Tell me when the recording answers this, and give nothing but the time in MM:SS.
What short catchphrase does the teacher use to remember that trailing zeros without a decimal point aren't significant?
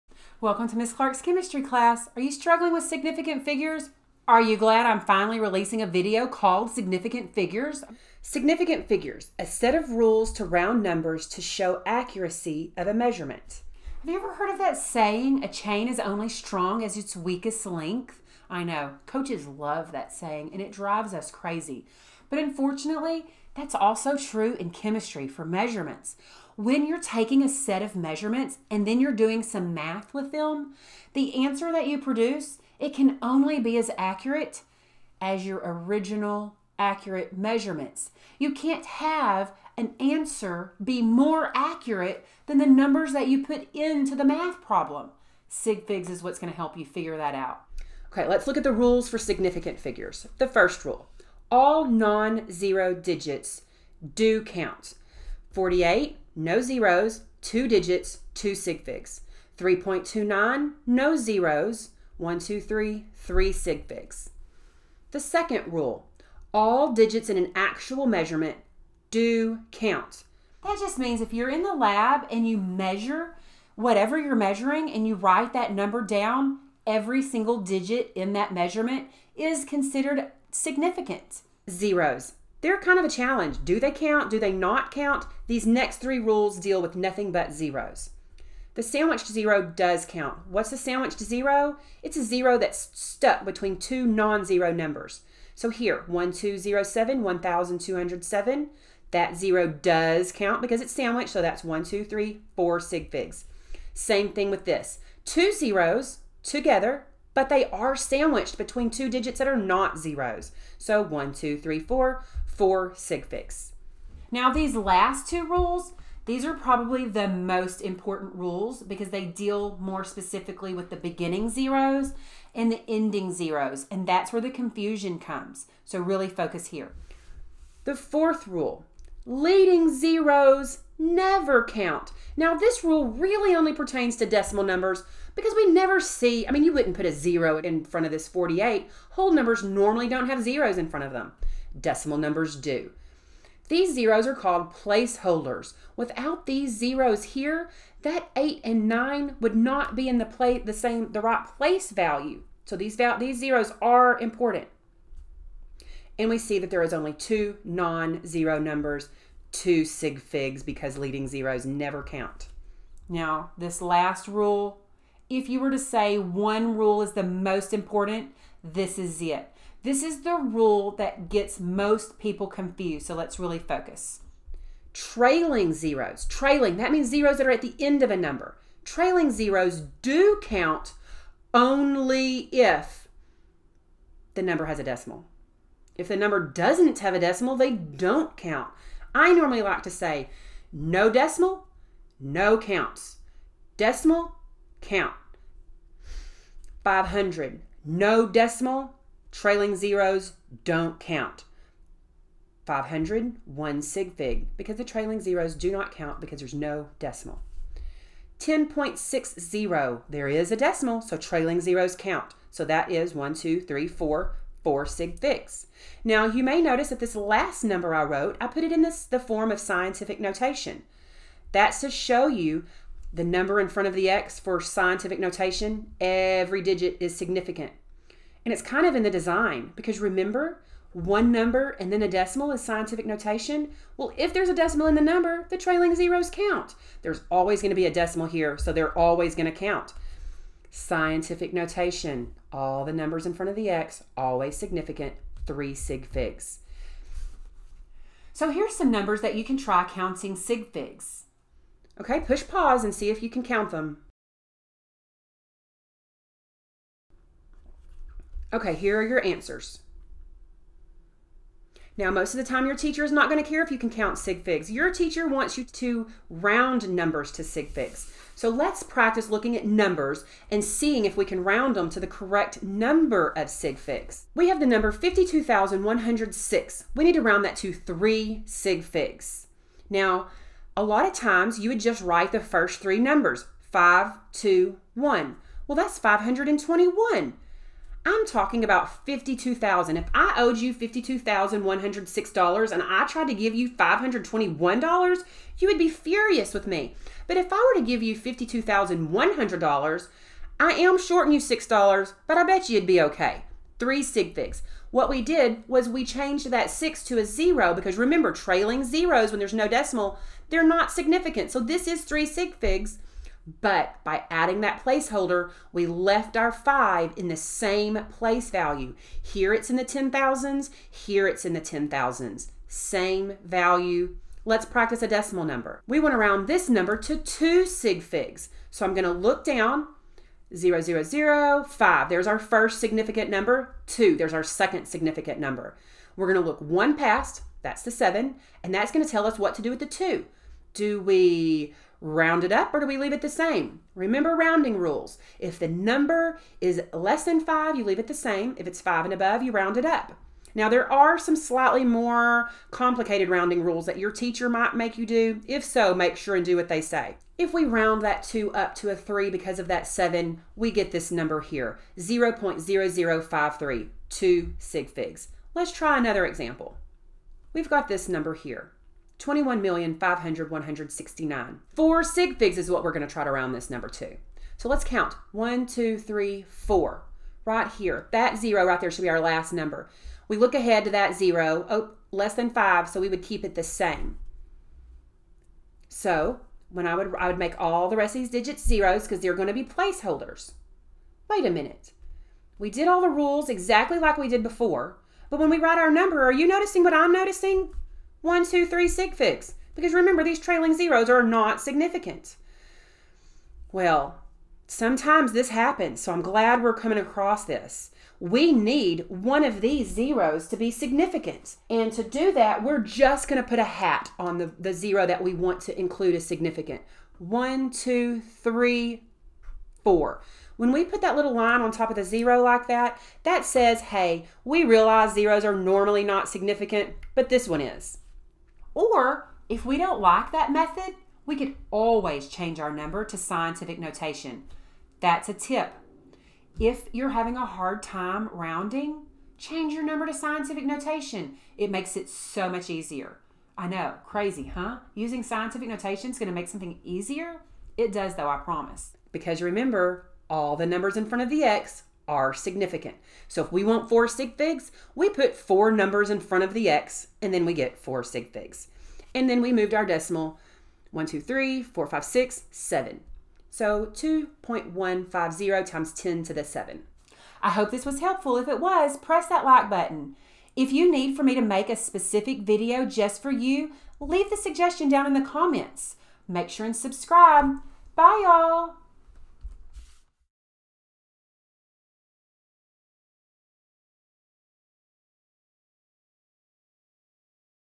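03:10.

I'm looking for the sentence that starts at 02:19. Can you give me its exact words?
Whole numbers normally don't have zeros in front of them decimal numbers do.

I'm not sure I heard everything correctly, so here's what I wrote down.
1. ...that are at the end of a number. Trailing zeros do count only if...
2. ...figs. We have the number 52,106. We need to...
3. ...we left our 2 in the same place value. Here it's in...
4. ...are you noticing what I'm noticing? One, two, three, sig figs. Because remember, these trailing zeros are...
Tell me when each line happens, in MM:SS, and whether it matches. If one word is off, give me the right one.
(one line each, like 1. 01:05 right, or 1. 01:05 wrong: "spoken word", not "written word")
1. 02:57 right
2. 04:33 right
3. 05:15 wrong: "5", not "2"
4. 06:36 right.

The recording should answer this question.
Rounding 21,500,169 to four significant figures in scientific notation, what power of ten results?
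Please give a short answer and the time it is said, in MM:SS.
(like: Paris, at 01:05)
10 to the 7, at 07:45.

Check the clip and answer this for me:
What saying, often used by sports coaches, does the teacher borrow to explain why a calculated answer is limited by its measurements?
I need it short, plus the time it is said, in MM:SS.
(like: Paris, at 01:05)
A chain is only strong as its weakest link, at 00:15.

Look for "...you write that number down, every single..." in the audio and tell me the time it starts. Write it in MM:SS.
01:15.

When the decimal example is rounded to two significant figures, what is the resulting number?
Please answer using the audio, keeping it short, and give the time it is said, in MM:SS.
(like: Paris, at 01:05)
0.0053, at 06:01.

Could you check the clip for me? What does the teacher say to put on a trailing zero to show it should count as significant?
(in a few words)
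A hat.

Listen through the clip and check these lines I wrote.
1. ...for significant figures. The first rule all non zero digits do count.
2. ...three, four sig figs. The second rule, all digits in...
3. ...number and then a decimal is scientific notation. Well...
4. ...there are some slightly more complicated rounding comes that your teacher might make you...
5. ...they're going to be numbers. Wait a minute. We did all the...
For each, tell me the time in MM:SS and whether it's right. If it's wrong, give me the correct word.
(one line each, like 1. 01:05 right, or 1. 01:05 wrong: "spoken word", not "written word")
1. 00:49 right
2. 01:02 wrong: "three", not "four"
3. 03:51 right
4. 05:50 wrong: "rules", not "comes"
5. 06:29 wrong: "placeholders", not "numbers".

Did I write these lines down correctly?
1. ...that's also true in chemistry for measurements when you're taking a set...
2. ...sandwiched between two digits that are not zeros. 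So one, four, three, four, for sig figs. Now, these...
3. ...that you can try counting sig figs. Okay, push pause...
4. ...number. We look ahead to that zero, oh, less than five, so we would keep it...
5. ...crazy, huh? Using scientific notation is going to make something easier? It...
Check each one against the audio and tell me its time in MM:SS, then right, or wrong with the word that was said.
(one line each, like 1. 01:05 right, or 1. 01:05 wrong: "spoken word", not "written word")
1. 00:23 right
2. 01:47 wrong: "two", not "four"
3. 04:09 right
4. 06:19 right
5. 07:24 right.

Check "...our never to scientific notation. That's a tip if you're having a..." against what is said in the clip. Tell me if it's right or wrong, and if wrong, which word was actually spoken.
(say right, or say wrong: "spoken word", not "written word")
wrong: "number", not "never".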